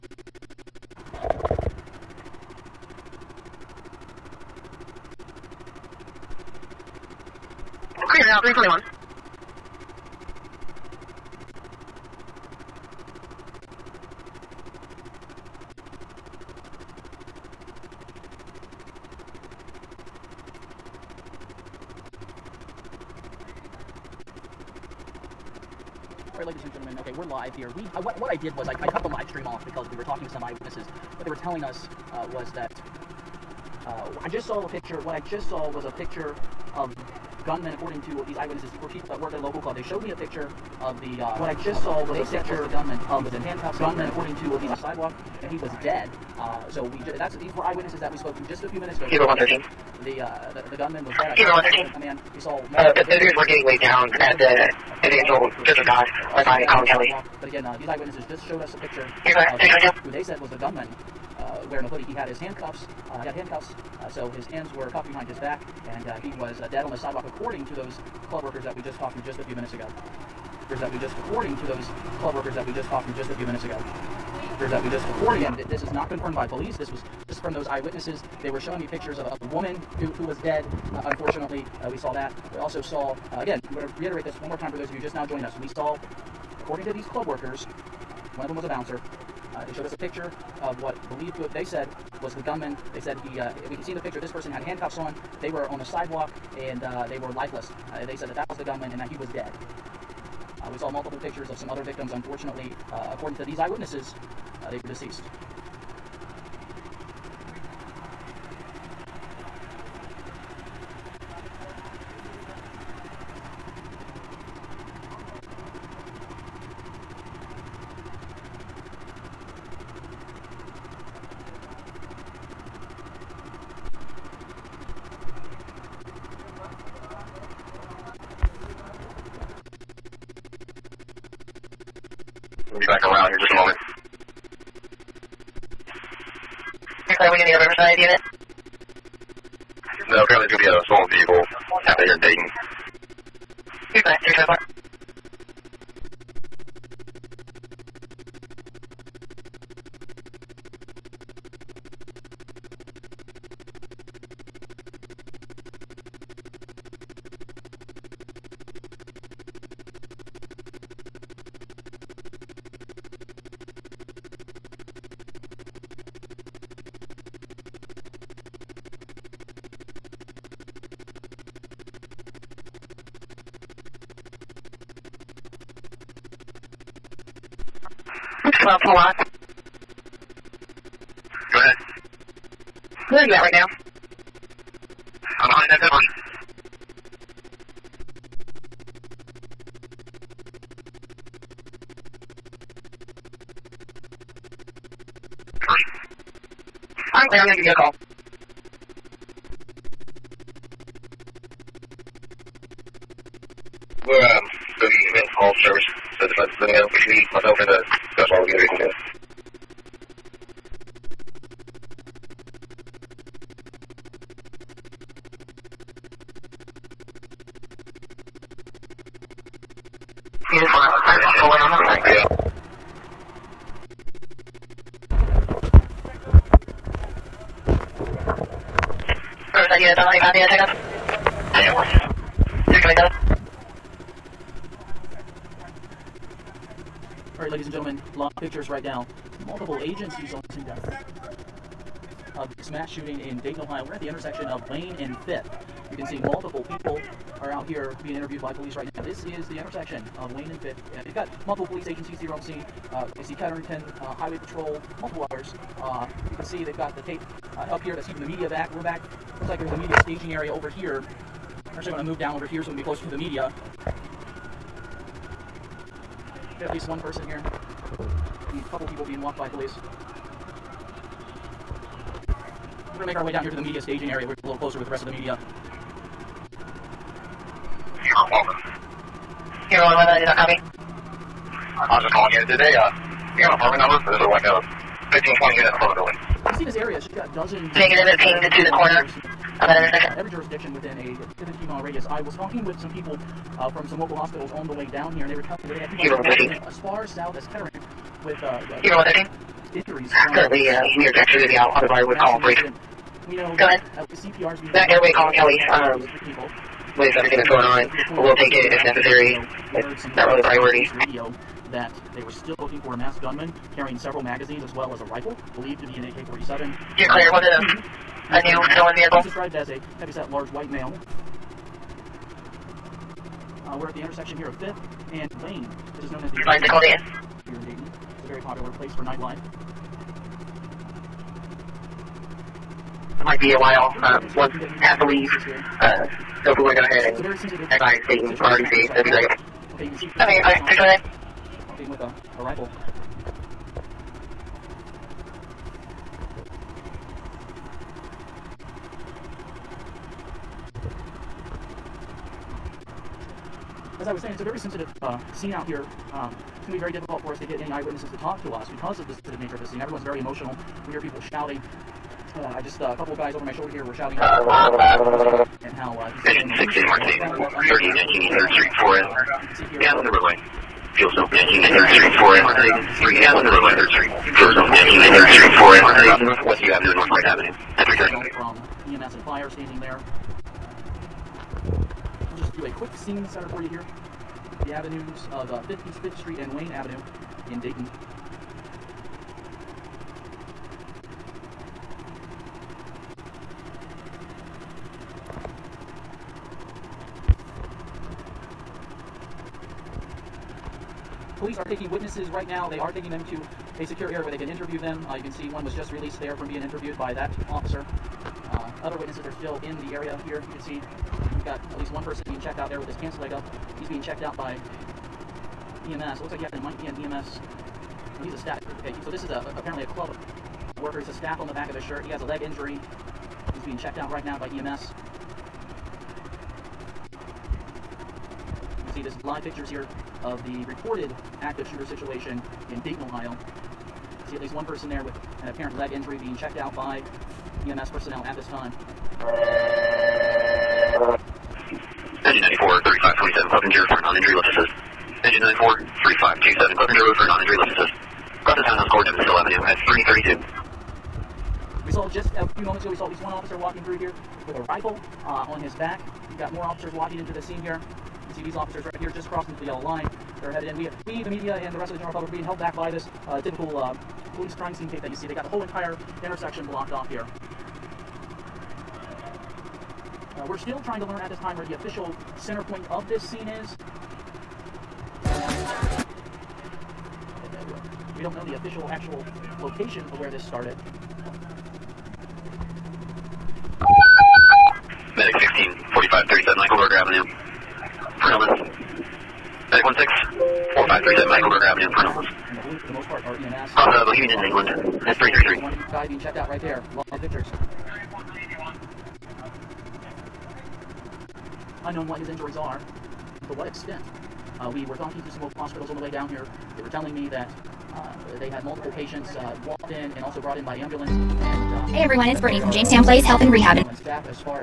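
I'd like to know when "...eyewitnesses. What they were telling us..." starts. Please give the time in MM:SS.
00:30.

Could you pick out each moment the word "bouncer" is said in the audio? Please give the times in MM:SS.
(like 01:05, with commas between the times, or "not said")
01:28.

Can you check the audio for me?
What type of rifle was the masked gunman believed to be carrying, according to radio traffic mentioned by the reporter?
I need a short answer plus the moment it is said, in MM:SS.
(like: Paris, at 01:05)
AK-47, at 05:16.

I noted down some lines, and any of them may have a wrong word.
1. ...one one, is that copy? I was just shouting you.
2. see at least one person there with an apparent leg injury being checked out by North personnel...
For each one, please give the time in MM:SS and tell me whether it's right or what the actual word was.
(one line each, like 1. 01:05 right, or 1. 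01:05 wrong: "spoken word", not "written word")
1. 04:39 wrong: "calling", not "shouting"
2. 07:14 wrong: "EMS", not "North".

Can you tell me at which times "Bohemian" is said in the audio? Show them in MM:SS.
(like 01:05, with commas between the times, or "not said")
08:14.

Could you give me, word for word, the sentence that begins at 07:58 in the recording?
don't know the official actual location of where this started.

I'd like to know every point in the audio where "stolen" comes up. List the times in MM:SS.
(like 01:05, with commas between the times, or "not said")
02:20, 05:18.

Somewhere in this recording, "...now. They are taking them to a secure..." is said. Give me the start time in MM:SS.
06:42.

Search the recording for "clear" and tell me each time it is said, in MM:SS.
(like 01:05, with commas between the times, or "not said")
00:08, 02:17, 03:17, 05:17.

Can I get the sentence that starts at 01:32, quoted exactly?
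They said he, uh, we can see in the picture, this person had handcuffs on.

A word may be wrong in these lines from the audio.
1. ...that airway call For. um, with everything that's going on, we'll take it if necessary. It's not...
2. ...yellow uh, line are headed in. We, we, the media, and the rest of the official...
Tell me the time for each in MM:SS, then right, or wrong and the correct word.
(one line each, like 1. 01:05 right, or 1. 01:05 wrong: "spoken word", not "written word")
1. 05:04 wrong: "Kelly", not "For"
2. 07:39 wrong: "general", not "official".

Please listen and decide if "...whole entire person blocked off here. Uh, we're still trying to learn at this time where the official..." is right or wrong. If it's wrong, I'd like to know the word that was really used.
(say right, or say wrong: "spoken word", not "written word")
wrong: "intersection", not "person".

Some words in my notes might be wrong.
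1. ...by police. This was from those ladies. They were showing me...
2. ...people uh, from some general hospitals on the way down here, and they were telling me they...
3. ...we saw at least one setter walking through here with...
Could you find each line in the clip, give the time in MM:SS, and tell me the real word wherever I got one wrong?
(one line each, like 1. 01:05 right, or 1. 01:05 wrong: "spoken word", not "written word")
1. 01:16 wrong: "eyewitnesses", not "ladies"
2. 04:52 wrong: "local", not "general"
3. 07:32 wrong: "officer", not "setter".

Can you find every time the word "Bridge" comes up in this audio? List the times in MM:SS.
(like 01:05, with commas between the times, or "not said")
05:02.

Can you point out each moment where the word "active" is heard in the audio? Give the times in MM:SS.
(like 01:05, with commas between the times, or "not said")
07:11.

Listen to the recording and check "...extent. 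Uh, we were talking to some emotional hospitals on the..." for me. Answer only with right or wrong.
wrong.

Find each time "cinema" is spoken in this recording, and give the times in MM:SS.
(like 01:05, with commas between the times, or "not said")
not said.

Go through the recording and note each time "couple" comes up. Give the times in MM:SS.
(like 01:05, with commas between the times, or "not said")
04:28, 06:02.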